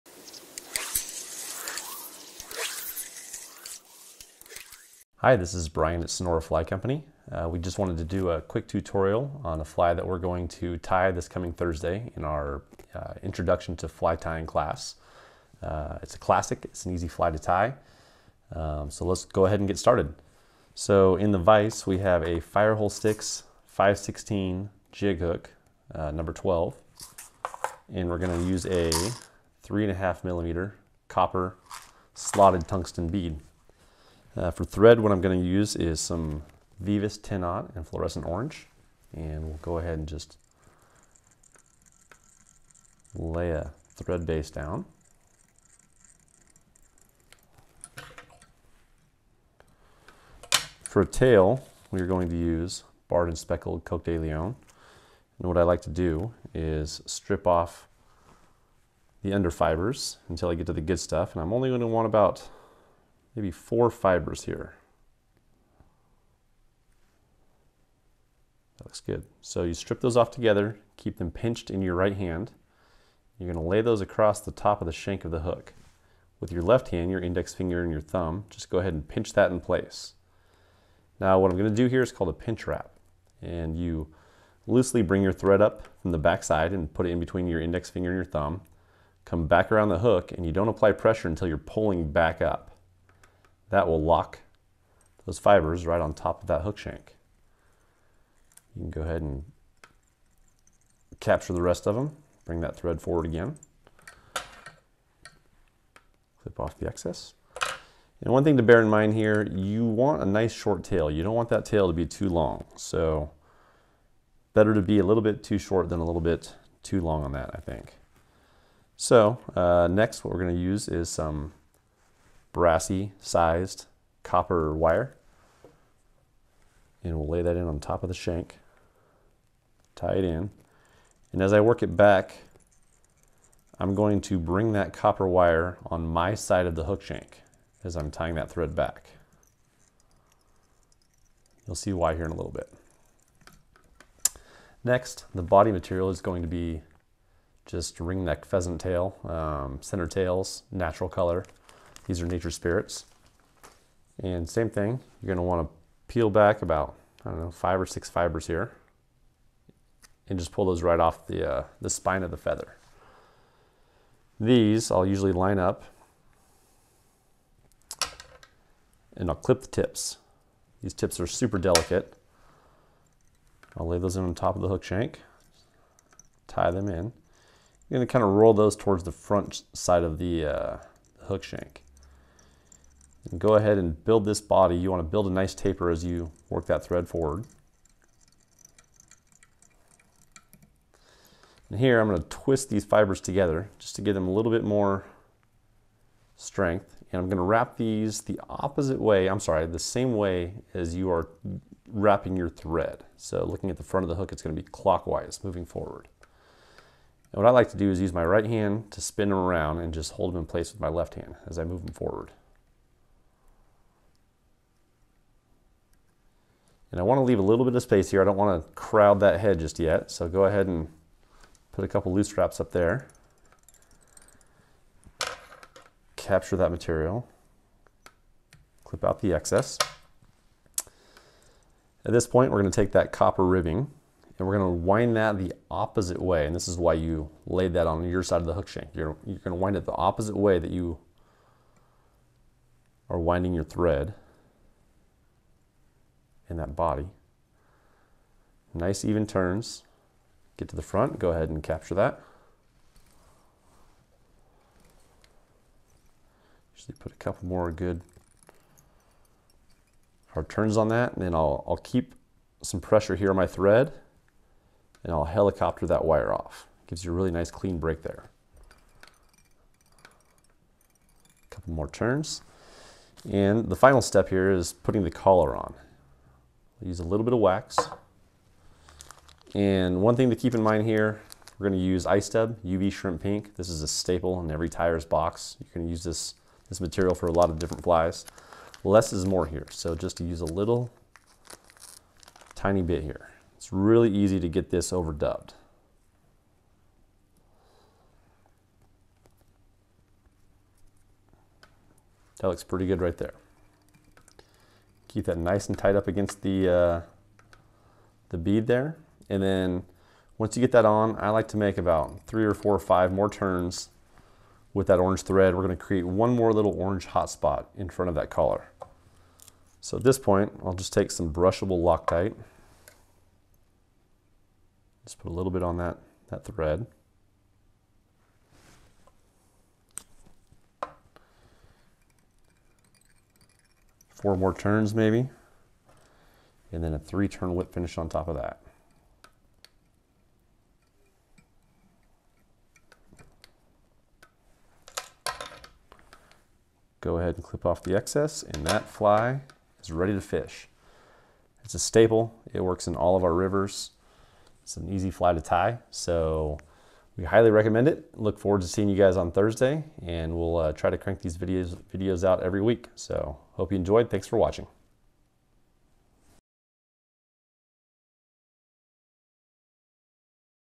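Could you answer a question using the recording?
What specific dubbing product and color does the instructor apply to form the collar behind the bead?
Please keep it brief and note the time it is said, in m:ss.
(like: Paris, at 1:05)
Ice Dub UV Shrimp Pink, at 4:42.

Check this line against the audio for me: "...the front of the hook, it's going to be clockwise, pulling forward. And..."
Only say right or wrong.
wrong.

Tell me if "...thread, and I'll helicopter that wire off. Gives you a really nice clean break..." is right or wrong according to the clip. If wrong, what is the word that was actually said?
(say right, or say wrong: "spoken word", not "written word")
right.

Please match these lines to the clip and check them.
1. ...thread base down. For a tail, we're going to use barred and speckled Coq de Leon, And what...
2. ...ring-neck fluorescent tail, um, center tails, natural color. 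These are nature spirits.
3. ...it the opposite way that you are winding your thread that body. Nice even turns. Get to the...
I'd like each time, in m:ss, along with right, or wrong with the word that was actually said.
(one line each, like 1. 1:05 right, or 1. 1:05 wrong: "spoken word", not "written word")
1. 0:43 right
2. 2:27 wrong: "pheasant", not "fluorescent"
3. 3:59 right.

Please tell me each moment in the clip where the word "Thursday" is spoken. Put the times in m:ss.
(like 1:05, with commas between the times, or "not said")
0:11, 5:59.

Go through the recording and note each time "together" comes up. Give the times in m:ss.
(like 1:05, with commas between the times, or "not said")
1:10, 3:13.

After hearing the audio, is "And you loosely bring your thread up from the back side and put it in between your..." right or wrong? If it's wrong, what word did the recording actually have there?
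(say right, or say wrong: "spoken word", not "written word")
right.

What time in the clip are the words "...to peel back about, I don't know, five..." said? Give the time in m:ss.
2:35.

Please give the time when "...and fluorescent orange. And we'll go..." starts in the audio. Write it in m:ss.
0:37.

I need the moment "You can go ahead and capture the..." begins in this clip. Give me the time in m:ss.
1:38.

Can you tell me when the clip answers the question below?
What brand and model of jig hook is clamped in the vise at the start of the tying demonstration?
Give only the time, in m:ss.
0:22.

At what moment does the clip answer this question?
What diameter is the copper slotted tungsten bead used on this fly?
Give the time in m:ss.
0:29.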